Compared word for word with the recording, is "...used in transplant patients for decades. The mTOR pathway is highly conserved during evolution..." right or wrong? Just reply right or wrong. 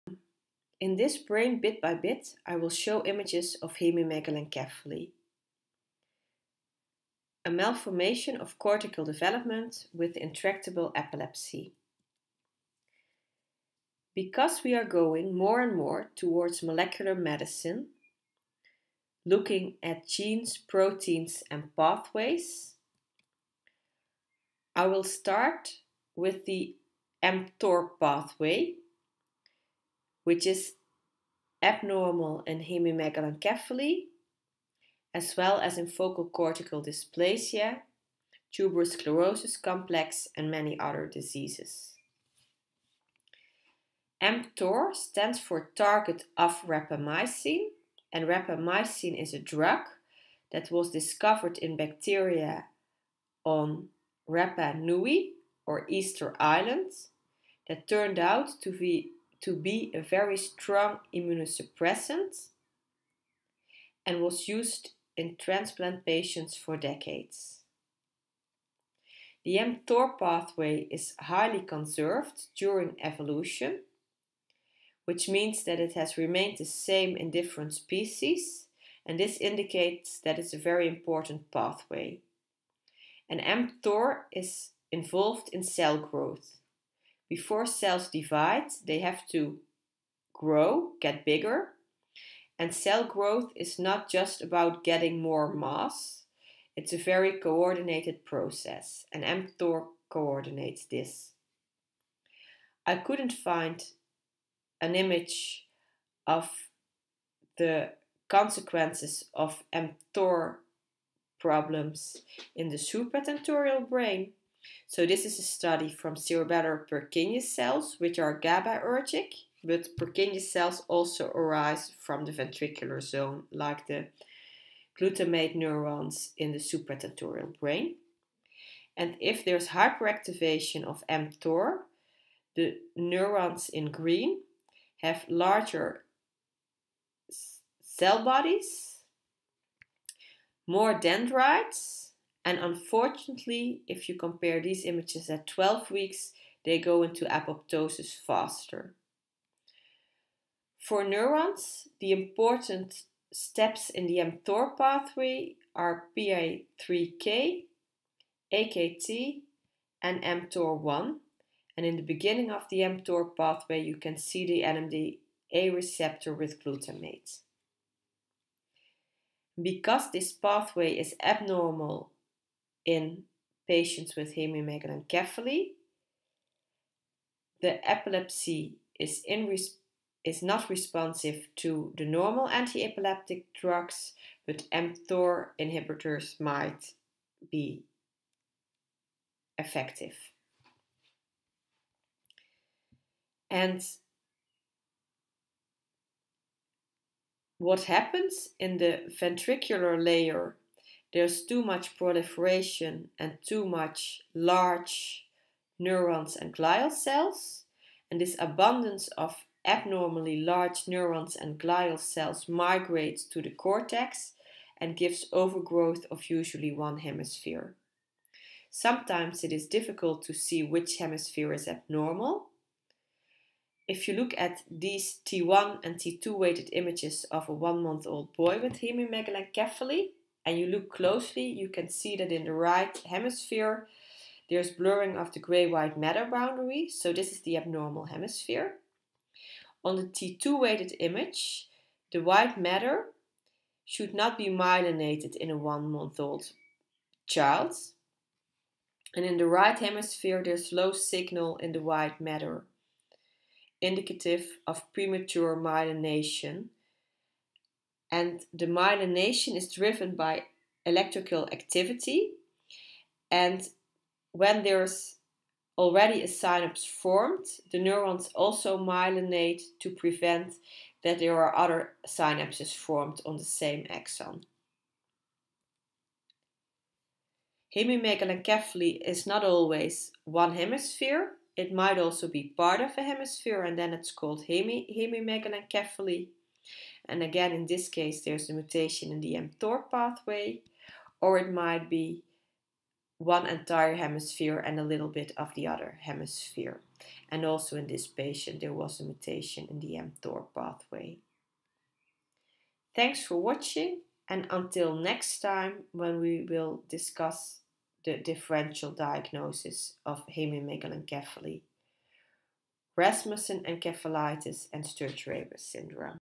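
right.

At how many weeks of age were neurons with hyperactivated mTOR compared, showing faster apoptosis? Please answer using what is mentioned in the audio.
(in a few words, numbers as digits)
12.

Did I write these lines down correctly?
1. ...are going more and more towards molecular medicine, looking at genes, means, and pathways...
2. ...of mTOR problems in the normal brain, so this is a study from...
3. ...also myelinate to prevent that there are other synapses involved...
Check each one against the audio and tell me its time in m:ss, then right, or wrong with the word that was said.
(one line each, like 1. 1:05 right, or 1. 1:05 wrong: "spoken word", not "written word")
1. 0:14 wrong: "proteins", not "means"
2. 1:49 wrong: "supratentorial", not "normal"
3. 4:28 wrong: "formed", not "involved".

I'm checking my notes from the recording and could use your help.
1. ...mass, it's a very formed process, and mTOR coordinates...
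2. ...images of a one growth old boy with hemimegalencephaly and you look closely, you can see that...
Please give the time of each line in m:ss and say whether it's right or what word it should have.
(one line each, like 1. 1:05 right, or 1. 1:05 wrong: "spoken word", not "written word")
1. 1:35 wrong: "coordinated", not "formed"
2. 3:46 wrong: "month", not "growth".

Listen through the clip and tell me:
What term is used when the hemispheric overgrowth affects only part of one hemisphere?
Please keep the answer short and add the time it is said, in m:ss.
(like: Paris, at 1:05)
hemi hemimegalencephaly, at 4:44.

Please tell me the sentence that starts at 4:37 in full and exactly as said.
Hemimegalencephaly is not always one hemisphere.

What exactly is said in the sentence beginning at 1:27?
Before cells divide, they have to grow, get bigger.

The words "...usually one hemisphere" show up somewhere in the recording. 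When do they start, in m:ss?
3:36.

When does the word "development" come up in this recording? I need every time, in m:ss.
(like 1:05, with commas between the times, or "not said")
0:09.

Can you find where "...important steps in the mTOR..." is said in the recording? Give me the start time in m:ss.
2:32.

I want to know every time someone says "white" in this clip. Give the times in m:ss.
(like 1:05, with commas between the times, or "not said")
3:55, 4:02, 4:11.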